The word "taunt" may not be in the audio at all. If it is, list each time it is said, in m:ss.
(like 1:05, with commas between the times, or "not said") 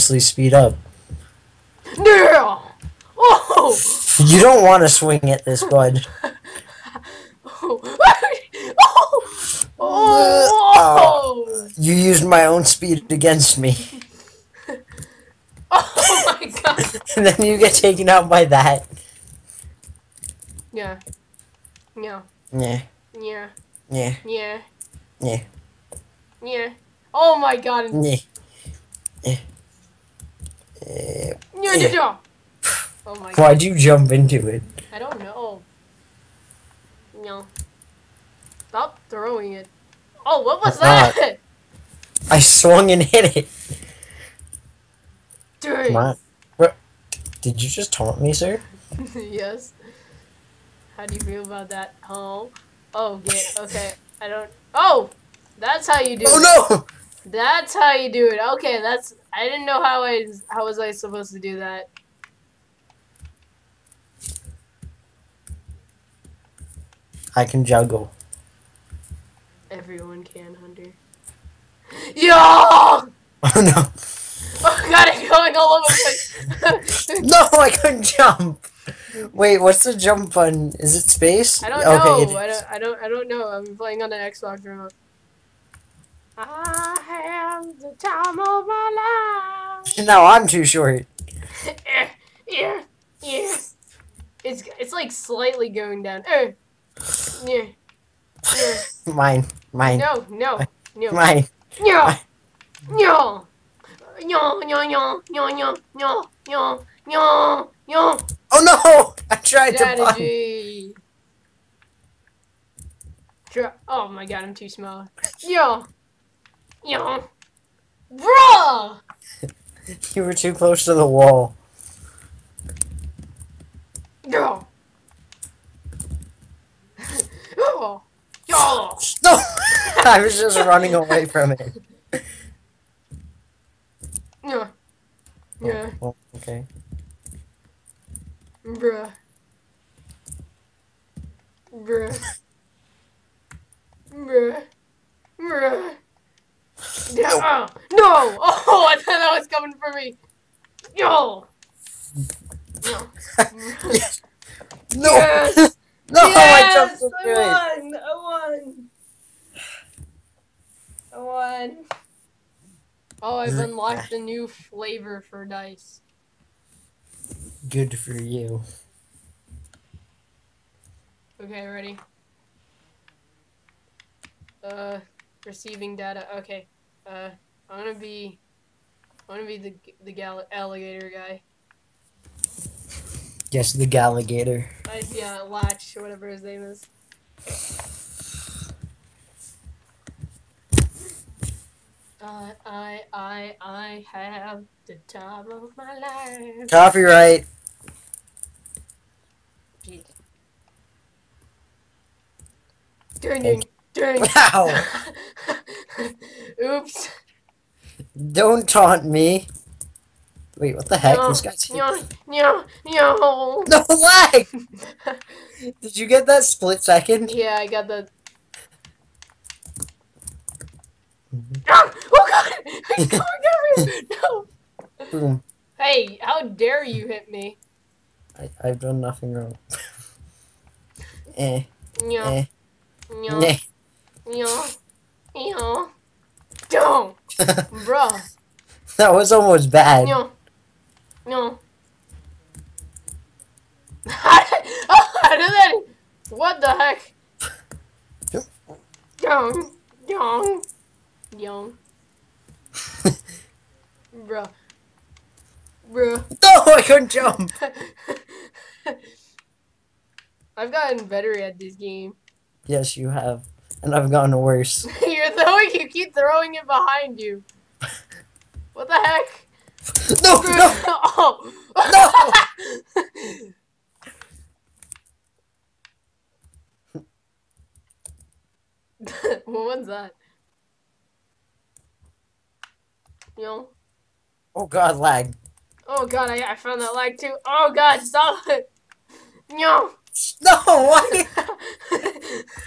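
0:47, 3:28.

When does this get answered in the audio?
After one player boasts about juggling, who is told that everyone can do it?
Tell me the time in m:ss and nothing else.
1:10.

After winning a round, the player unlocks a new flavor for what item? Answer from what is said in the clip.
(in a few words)
dice.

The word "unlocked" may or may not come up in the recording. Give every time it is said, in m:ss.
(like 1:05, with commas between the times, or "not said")
2:43.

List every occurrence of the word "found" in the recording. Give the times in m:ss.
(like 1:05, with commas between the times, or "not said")
4:46.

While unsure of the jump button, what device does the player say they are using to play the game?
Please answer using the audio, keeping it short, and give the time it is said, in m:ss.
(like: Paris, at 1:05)
Xbox remote, at 1:24.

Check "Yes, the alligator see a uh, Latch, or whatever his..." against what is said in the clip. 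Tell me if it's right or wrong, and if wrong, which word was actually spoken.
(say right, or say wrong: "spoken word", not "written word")
right.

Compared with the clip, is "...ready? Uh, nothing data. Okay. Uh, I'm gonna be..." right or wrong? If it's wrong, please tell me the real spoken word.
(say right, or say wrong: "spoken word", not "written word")
wrong: "receiving", not "nothing".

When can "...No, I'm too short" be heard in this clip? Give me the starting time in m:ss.
1:30.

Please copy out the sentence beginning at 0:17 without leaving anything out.
and then you get taken out by that.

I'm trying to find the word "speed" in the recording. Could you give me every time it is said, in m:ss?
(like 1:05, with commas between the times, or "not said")
0:00, 0:12.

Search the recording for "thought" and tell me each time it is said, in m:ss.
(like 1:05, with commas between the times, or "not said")
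2:28.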